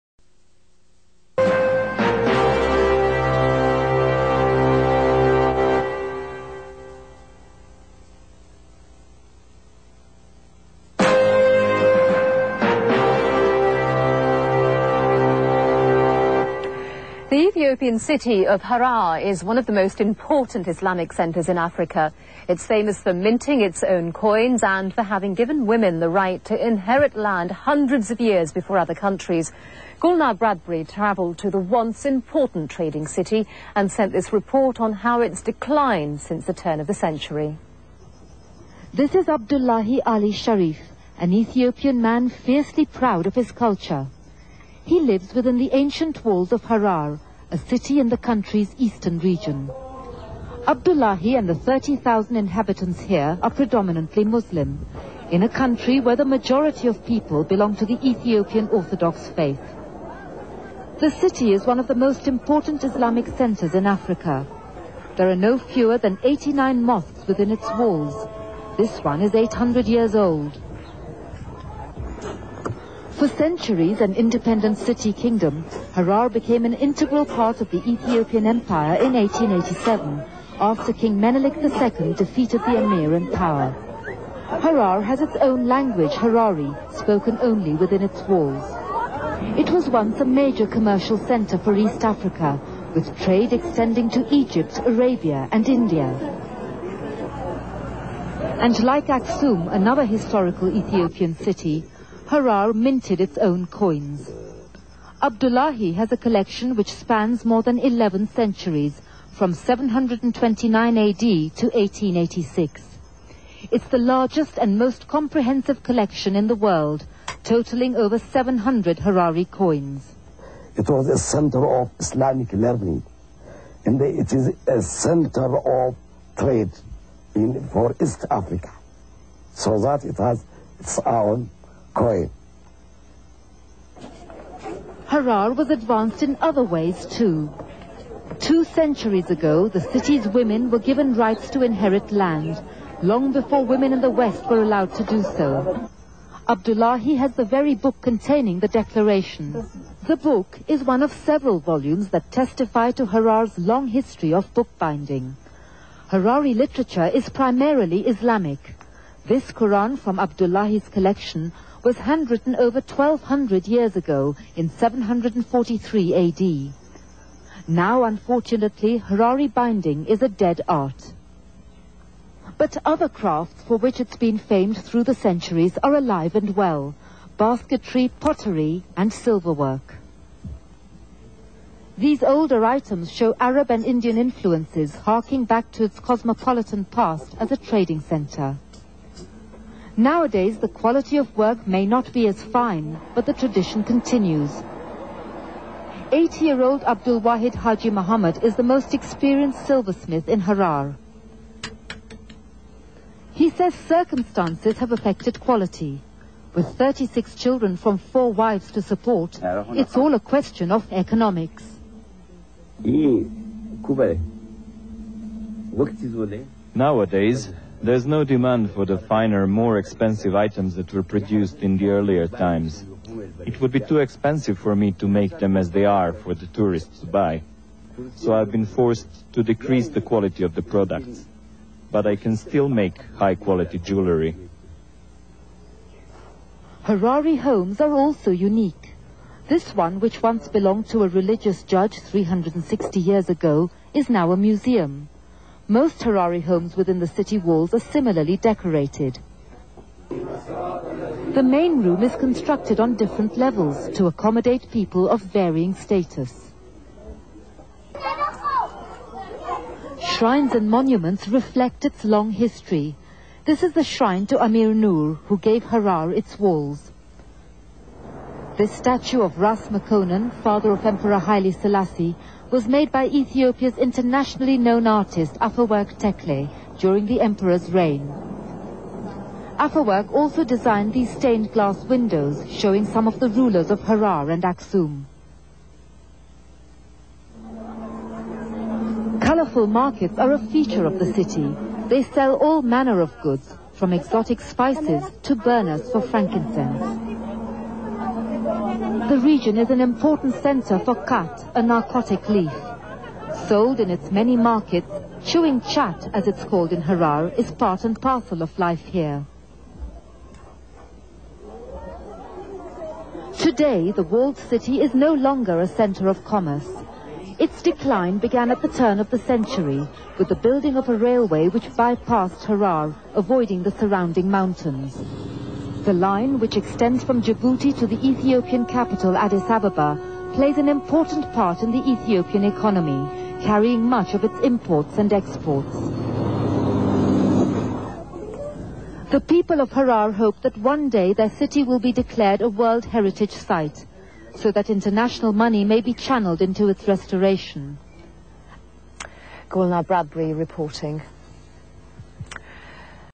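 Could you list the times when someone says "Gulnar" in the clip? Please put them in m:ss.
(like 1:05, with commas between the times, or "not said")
0:30, 5:49.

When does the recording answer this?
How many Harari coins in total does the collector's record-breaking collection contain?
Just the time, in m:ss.
1:57.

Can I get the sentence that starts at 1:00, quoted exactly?
The city is one of the most important Islamic centers in Africa.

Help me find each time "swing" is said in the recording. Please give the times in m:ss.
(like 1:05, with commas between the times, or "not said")
not said.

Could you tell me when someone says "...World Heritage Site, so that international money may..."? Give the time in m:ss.
5:42.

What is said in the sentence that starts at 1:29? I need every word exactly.
It was once a major commercial center for East Africa, with trade extending to Egypt, Arabia and India.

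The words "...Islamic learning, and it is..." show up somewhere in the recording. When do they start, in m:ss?
2:01.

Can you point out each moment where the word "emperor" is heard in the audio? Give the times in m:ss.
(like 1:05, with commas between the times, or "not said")
4:30, 4:37.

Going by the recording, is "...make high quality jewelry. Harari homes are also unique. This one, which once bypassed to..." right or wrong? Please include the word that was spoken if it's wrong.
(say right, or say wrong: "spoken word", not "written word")
wrong: "belonged", not "bypassed".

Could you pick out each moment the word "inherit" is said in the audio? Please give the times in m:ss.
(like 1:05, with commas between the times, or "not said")
0:26, 2:21.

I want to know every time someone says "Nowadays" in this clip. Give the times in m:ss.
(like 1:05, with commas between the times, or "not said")
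3:10, 3:36.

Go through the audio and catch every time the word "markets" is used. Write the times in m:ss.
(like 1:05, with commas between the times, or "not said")
4:49, 5:04.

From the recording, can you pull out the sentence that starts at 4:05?
Most Harari homes within the city walls are similarly decorated.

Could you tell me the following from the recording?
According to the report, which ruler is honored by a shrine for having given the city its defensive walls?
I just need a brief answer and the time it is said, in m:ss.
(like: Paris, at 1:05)
Amir Noor, at 4:24.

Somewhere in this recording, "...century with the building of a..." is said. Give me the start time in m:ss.
5:19.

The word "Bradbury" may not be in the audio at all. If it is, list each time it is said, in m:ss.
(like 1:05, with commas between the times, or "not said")
0:30, 5:49.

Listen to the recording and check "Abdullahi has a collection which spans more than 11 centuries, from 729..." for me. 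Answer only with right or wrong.
right.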